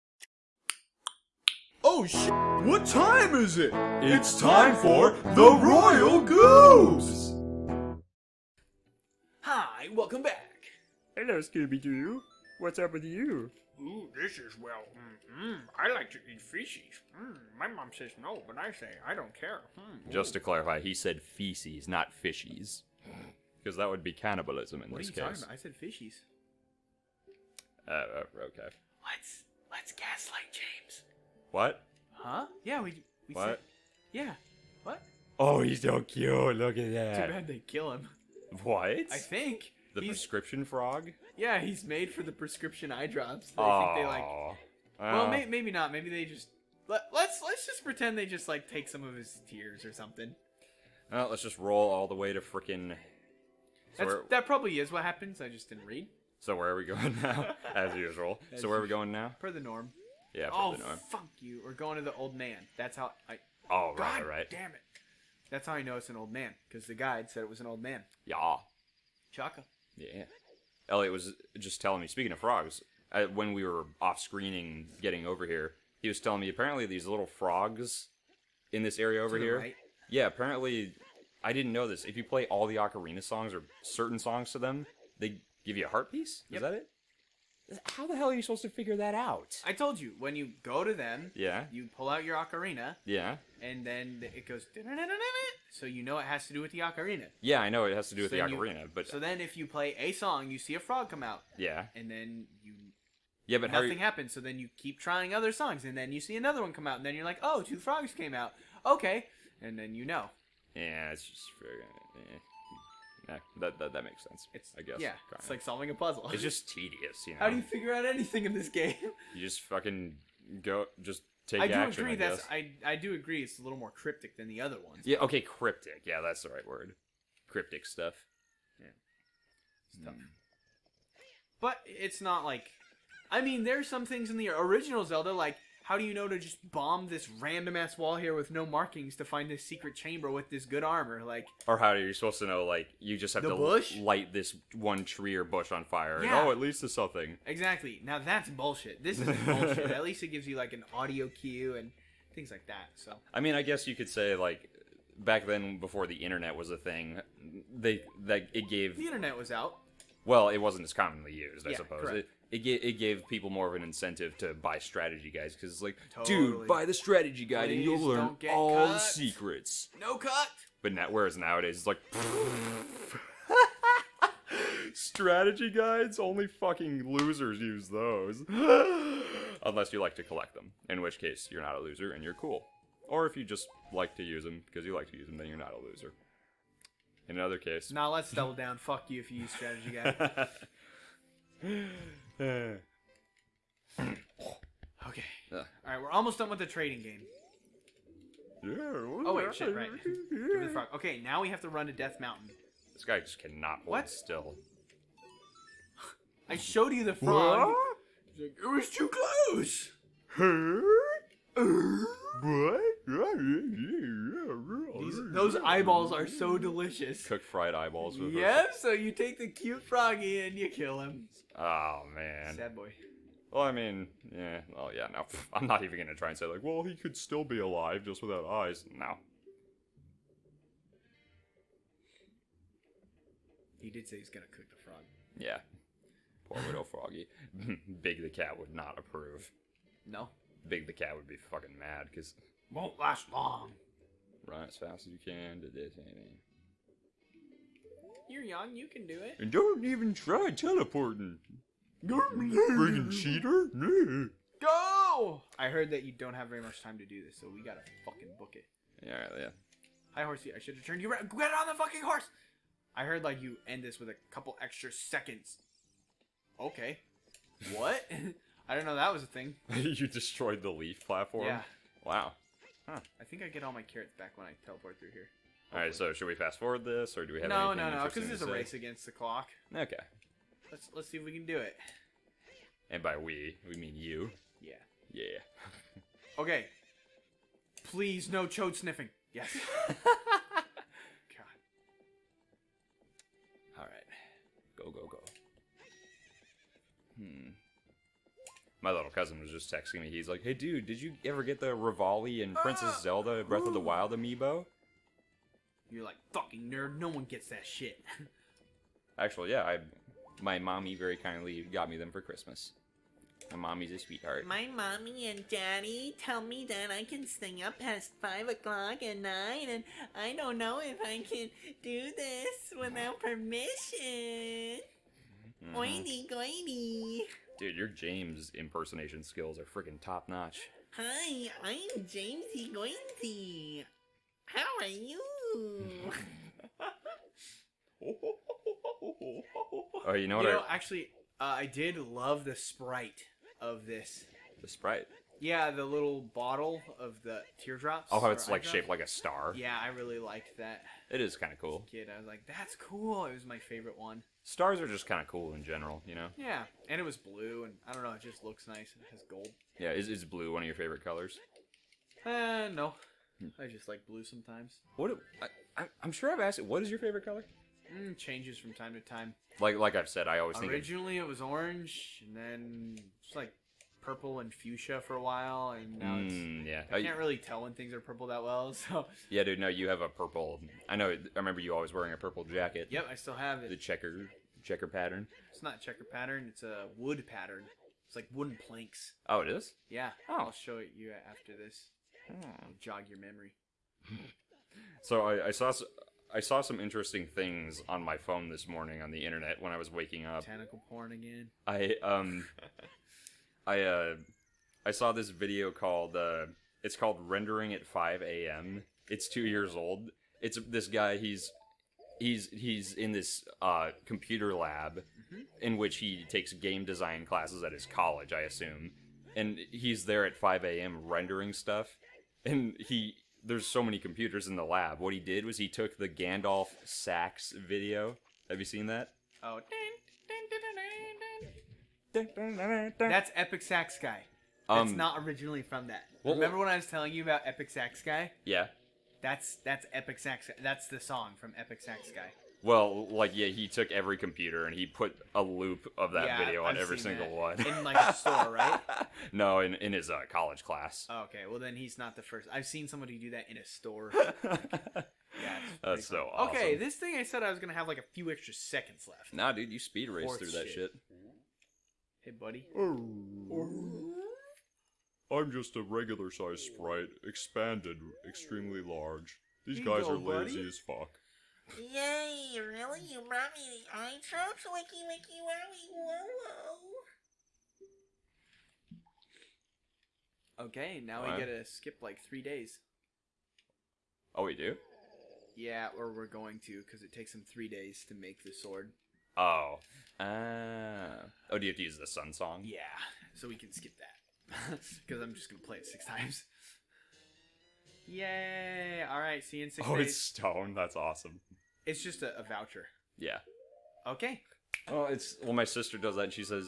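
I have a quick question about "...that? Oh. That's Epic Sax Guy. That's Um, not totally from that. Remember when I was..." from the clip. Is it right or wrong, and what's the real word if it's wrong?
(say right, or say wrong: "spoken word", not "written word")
wrong: "originally", not "totally".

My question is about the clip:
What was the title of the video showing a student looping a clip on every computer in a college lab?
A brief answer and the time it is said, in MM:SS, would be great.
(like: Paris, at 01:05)
Rendering at 5 a.m., at 06:47.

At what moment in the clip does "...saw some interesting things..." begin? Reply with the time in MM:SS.
06:36.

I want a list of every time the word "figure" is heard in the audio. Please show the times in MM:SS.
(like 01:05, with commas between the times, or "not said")
01:28, 01:57.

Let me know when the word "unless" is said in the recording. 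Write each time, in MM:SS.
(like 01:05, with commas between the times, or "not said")
02:59.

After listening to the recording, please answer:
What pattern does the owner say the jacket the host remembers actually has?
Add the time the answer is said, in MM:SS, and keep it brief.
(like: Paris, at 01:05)
Wood pattern, at 06:26.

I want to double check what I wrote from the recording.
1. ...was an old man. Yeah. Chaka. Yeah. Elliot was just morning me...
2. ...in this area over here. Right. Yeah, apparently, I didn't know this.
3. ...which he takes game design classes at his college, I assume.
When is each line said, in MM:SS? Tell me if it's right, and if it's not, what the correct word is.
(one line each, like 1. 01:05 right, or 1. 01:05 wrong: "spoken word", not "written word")
1. 01:07 wrong: "telling", not "morning"
2. 01:18 right
3. 06:55 right.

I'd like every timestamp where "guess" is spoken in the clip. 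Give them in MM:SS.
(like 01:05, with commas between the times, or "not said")
01:54, 02:33.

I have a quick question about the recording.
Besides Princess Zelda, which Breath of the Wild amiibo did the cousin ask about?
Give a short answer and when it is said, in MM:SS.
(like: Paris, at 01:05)
Revali, at 05:01.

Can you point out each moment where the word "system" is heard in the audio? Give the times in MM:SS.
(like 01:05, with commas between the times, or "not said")
not said.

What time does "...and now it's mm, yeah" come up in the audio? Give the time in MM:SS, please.
06:15.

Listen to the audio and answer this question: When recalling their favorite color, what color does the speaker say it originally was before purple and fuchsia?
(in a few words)
Orange.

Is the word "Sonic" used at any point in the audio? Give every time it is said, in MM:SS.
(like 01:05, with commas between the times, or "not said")
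not said.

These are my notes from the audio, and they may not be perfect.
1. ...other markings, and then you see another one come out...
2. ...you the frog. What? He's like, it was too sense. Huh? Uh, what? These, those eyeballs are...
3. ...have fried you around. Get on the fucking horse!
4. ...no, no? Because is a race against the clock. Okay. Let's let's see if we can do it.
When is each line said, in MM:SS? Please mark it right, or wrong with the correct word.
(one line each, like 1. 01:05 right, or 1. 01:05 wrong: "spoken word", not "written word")
1. 01:45 wrong: "songs", not "markings"
2. 03:26 wrong: "close", not "sense"
3. 04:20 wrong: "turned", not "fried"
4. 04:37 right.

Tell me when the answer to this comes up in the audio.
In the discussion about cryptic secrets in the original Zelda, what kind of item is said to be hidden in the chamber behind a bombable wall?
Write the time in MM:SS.
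02:20.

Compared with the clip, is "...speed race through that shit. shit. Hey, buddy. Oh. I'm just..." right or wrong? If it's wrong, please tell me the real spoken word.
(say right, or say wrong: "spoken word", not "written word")
right.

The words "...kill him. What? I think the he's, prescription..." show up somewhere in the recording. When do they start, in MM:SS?
00:37.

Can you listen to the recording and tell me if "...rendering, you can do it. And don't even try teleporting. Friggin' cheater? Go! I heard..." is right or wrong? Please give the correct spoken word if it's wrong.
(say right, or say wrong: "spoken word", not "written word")
wrong: "young", not "rendering".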